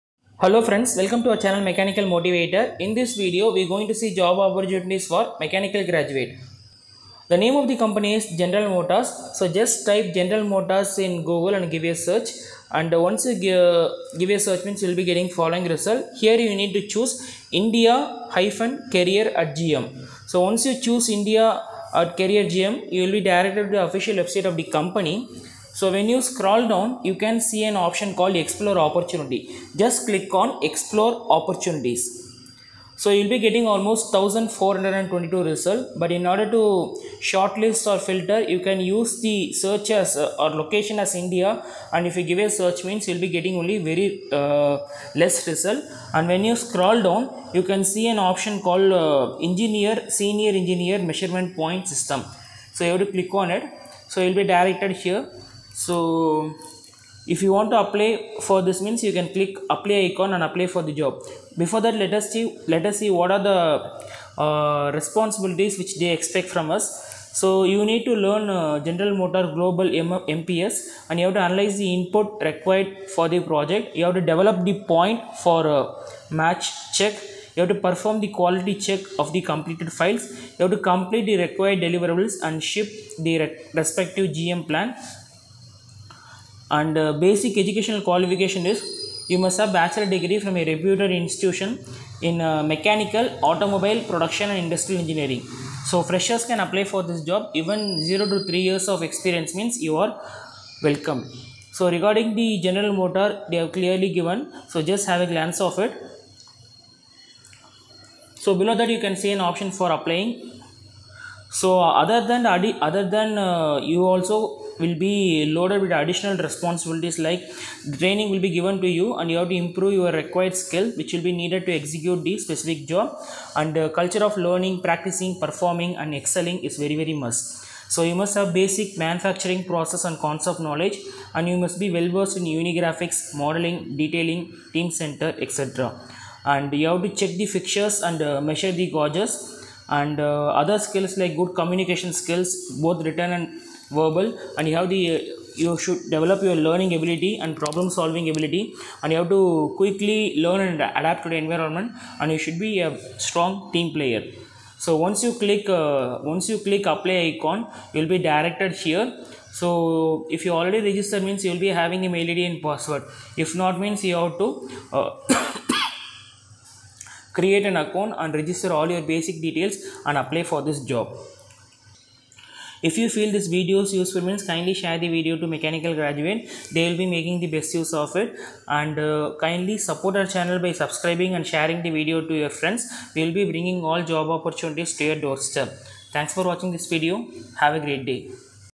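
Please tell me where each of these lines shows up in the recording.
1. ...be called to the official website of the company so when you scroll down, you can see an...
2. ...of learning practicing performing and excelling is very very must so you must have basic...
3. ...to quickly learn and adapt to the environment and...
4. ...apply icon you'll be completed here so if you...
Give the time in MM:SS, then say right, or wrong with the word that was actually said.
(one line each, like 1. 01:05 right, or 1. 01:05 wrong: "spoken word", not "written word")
1. 00:23 wrong: "directed", not "called"
2. 02:04 right
3. 02:29 right
4. 02:36 wrong: "directed", not "completed".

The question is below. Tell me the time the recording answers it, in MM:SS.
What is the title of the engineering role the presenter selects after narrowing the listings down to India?
00:50.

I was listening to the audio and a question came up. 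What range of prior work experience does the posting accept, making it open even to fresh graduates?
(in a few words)
0 to 3 years.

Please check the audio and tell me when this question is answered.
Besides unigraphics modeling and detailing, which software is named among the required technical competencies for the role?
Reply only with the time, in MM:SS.
02:14.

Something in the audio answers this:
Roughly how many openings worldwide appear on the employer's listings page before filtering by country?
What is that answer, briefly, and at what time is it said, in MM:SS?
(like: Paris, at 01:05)
1422, at 00:34.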